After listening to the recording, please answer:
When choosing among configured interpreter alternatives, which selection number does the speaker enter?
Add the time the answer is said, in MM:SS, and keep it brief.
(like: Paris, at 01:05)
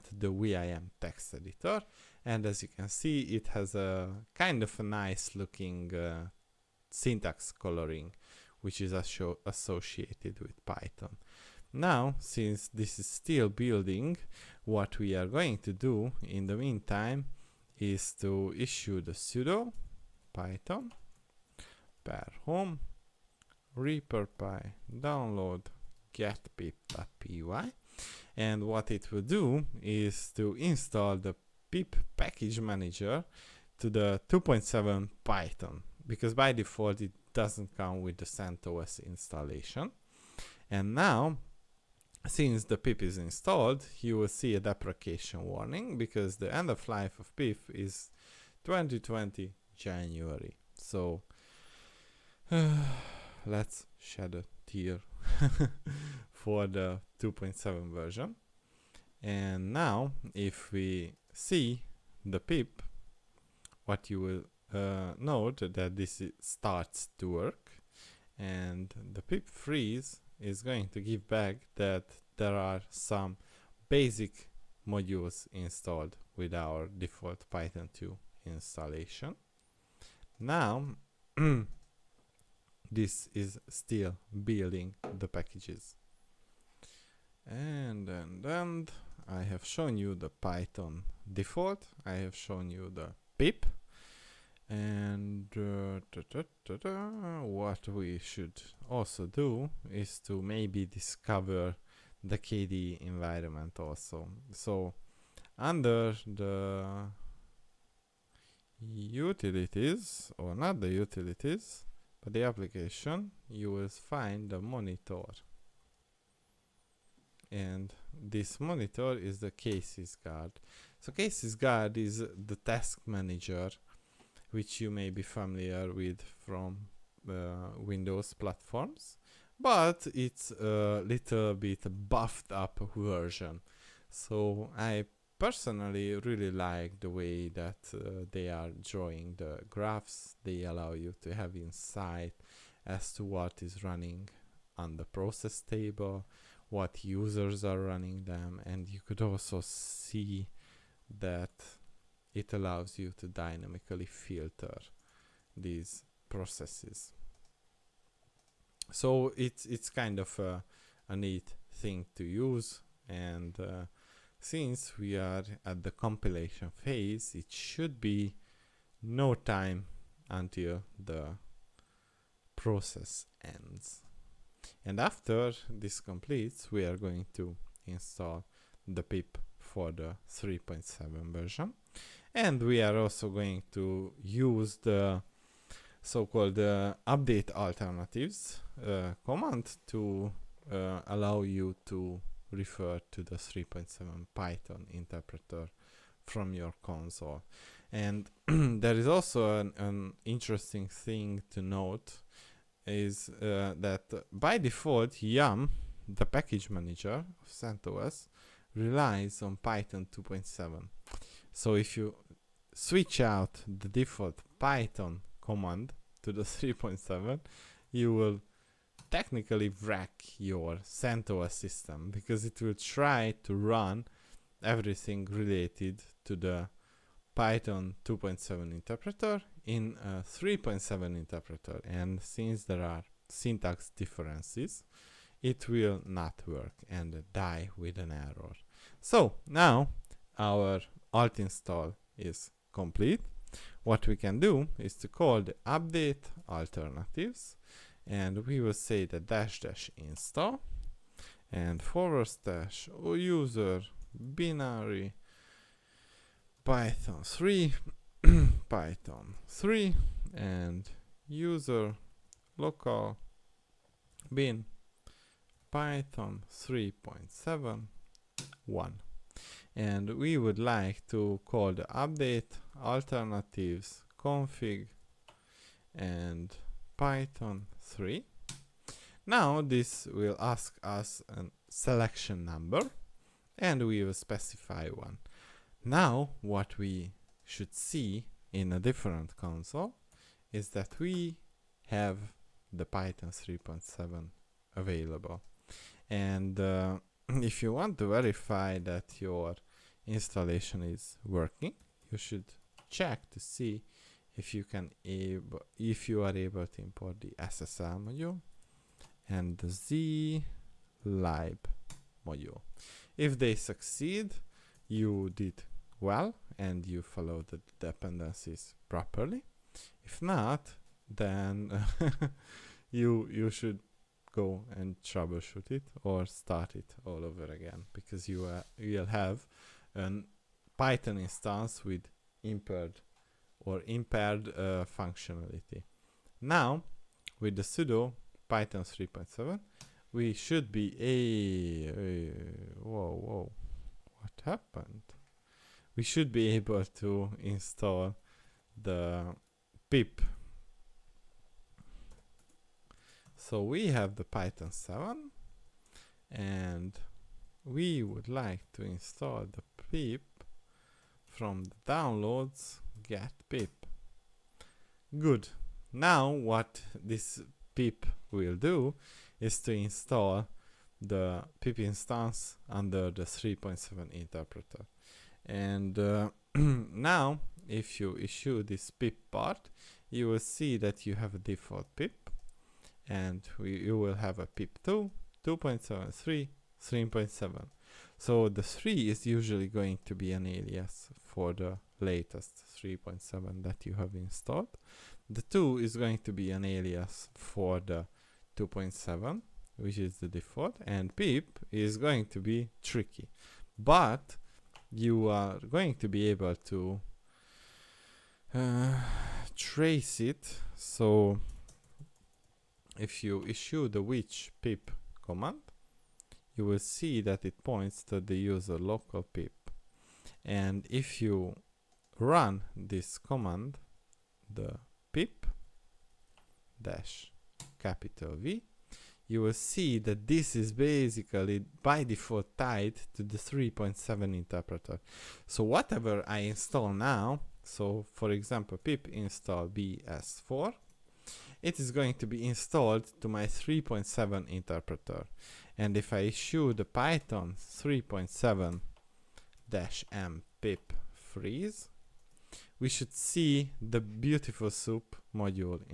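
1, at 04:44.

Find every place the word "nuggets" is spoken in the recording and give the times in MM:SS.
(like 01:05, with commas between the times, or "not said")
not said.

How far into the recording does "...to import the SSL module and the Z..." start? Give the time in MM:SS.
05:06.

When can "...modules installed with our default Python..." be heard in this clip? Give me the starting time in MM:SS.
01:14.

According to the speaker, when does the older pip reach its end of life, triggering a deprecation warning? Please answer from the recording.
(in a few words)
January 2020.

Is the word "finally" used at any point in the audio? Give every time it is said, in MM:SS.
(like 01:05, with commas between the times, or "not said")
not said.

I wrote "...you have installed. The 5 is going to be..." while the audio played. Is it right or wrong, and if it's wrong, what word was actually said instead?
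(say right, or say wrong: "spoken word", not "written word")
wrong: "2", not "5".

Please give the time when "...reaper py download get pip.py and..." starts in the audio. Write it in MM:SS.
00:23.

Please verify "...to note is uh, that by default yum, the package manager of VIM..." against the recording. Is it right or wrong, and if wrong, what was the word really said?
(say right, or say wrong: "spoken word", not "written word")
wrong: "CentOS", not "VIM".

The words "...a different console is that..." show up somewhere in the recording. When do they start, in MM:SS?
04:48.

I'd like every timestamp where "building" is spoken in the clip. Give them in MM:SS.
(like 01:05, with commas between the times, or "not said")
00:13, 01:24.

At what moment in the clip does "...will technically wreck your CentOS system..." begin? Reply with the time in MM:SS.
03:38.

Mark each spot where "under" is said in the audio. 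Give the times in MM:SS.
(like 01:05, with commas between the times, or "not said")
01:45, 06:12.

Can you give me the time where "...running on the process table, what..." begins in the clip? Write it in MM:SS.
02:23.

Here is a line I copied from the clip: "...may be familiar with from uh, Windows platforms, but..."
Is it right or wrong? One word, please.
right.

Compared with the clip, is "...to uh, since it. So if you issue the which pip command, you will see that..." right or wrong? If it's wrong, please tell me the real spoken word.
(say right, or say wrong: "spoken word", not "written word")
wrong: "trace", not "since".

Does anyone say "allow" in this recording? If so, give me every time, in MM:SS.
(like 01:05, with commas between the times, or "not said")
02:20, 02:32, 03:11.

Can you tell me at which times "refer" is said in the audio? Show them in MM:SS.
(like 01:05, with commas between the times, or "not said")
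03:12.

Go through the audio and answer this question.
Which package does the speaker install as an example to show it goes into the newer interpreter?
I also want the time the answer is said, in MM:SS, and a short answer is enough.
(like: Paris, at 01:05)
bs4, at 07:19.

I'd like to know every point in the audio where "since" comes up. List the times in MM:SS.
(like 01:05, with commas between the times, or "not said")
00:12, 00:42, 02:44, 03:52.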